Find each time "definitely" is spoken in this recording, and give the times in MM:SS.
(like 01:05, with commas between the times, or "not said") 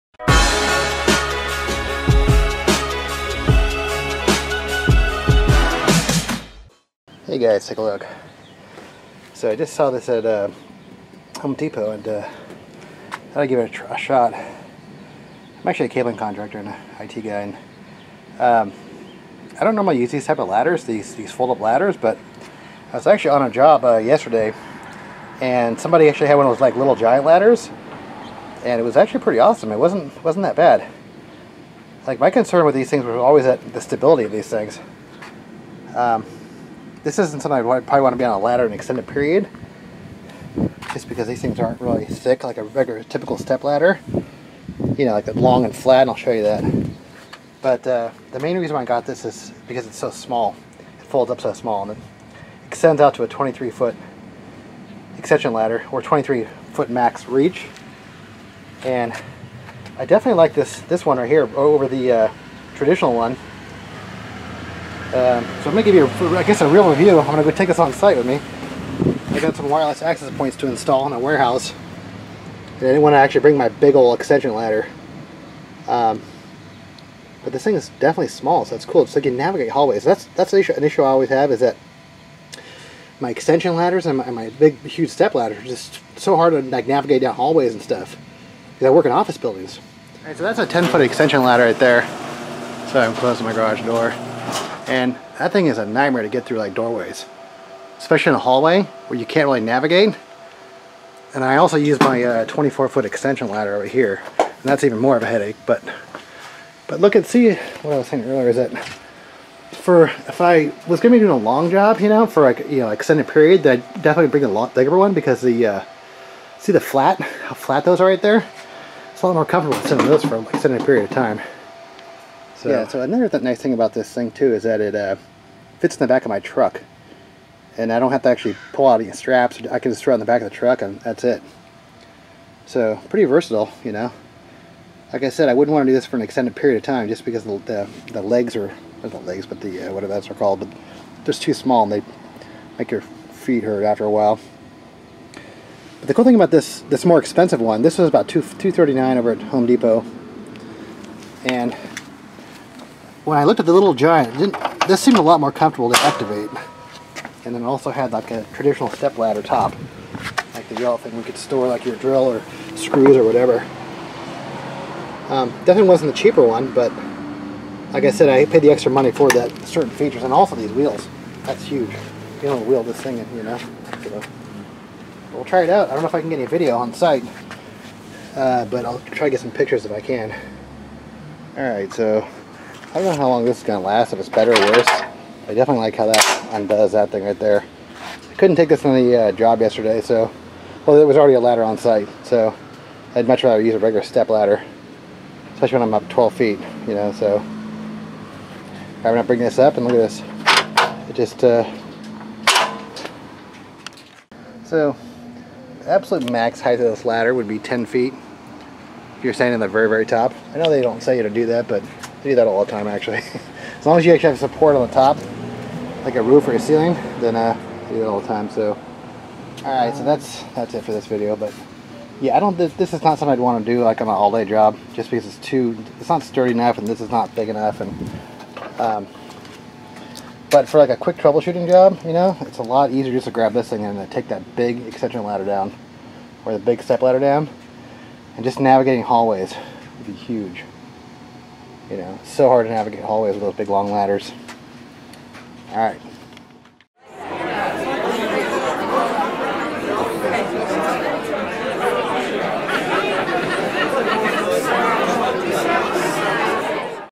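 01:00, 01:17, 01:54, 02:45, 03:05.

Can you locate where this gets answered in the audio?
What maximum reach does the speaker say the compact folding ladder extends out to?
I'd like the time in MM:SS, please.
00:56.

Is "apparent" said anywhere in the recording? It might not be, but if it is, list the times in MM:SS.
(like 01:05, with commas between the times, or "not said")
not said.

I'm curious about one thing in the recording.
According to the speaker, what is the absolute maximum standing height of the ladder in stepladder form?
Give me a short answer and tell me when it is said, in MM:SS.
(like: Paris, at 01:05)
10 feet, at 03:27.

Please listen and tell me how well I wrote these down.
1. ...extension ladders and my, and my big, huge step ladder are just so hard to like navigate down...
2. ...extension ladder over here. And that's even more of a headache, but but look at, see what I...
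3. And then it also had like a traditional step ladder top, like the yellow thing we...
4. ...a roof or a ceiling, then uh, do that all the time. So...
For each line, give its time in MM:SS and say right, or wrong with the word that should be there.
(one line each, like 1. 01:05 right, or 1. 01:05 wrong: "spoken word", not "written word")
1. 01:23 right
2. 01:43 right
3. 02:37 right
4. 03:36 right.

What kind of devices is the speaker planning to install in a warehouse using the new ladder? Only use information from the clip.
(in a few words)
wireless access points.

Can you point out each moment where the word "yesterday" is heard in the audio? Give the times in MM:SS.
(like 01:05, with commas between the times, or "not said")
00:23, 03:09.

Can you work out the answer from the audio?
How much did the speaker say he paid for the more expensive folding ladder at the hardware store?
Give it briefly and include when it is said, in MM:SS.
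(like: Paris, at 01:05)
$239, at 02:28.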